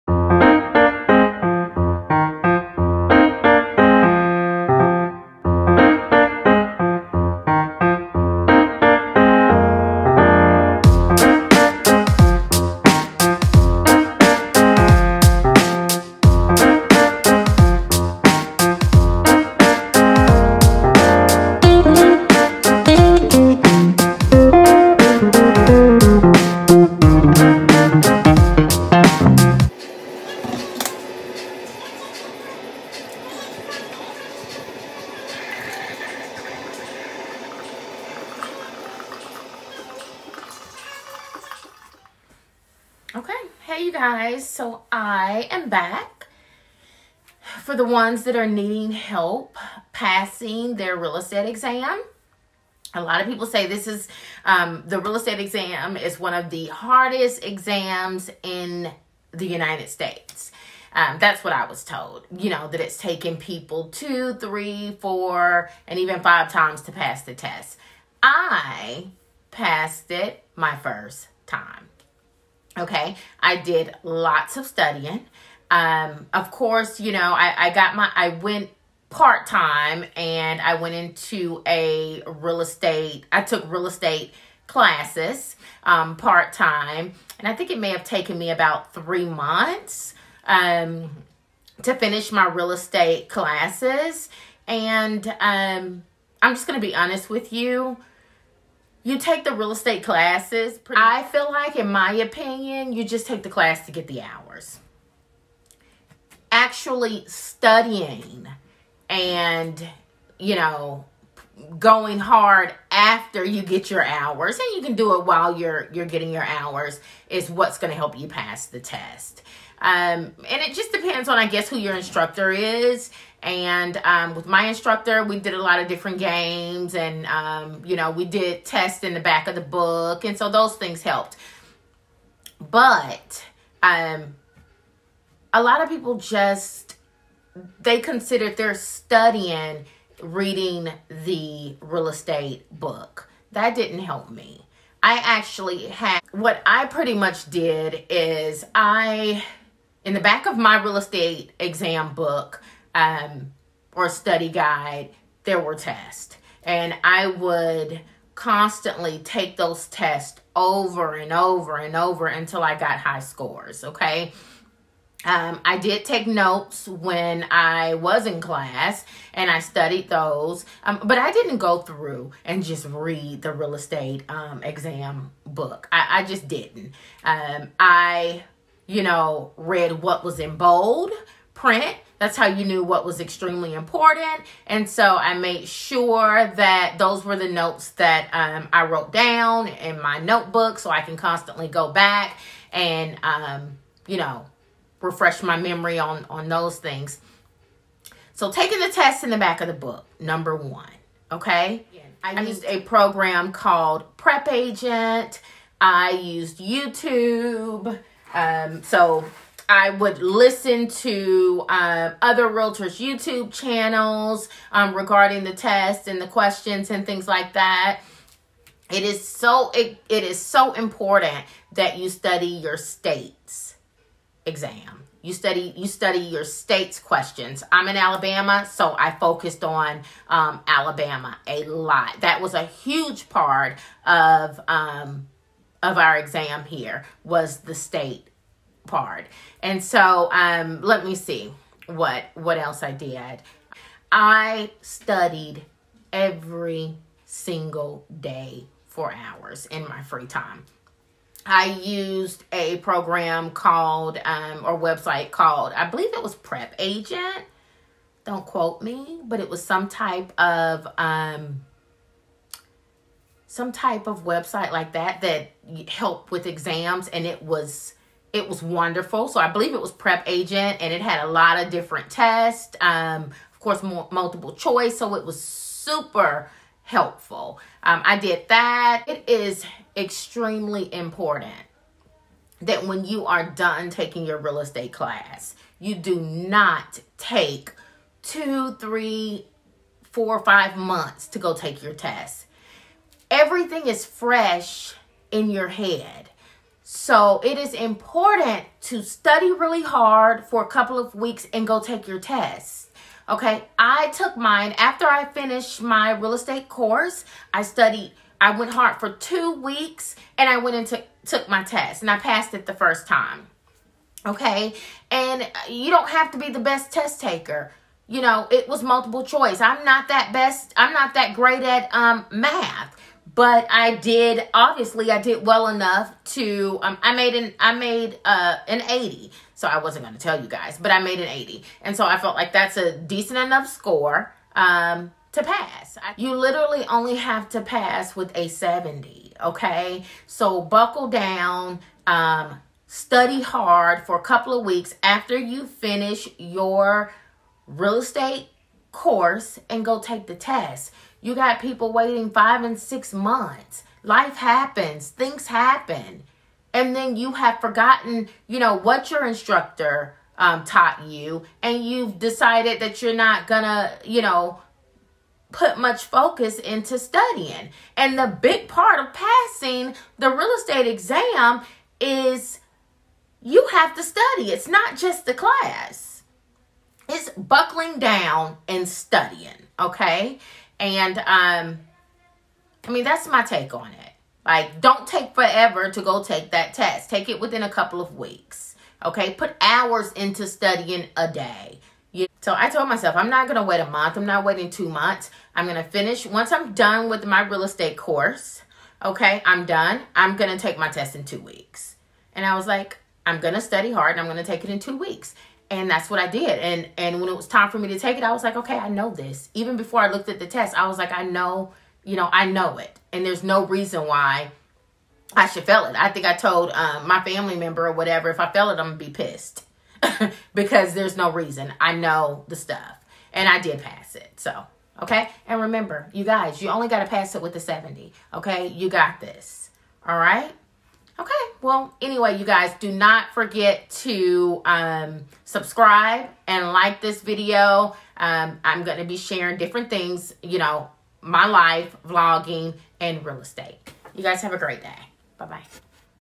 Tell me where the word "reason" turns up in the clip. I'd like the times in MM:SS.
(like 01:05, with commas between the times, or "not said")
06:53, 07:01.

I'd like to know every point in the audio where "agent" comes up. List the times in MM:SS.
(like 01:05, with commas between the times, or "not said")
03:24, 04:16, 04:30.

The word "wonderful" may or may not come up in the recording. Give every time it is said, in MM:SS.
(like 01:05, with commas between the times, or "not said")
04:28.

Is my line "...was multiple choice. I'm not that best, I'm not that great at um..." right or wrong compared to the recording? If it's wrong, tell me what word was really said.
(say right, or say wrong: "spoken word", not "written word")
right.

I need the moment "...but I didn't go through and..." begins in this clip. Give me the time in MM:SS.
02:51.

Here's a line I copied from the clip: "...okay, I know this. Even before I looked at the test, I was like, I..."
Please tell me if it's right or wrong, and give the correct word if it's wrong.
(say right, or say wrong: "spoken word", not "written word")
right.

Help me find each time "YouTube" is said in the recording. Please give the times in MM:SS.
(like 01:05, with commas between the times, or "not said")
03:26, 03:32.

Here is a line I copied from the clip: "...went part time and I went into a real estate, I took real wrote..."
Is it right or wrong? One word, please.
wrong.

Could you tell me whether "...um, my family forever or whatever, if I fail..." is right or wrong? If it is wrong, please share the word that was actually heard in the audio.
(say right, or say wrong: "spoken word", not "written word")
wrong: "member", not "forever".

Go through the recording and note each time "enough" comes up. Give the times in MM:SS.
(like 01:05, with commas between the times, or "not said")
05:25, 05:33.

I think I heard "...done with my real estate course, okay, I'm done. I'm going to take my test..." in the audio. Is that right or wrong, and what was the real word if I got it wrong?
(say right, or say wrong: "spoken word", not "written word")
right.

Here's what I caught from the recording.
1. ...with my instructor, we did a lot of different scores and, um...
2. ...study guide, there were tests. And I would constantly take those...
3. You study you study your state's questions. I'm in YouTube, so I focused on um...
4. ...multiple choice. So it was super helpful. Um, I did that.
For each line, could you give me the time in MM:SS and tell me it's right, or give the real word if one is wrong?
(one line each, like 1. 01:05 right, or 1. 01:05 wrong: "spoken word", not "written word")
1. 02:04 wrong: "games", not "scores"
2. 02:34 right
3. 03:45 wrong: "Alabama", not "YouTube"
4. 04:34 right.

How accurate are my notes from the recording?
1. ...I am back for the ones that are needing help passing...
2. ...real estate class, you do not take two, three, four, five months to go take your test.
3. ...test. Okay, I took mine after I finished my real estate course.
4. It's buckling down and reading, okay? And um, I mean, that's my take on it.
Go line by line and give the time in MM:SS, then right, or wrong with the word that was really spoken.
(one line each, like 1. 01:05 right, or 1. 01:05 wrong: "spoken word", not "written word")
1. 00:44 right
2. 04:44 right
3. 05:02 right
4. 06:17 wrong: "studying", not "reading".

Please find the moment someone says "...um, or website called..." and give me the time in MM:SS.
04:14.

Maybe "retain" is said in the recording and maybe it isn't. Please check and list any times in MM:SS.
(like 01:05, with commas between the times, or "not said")
not said.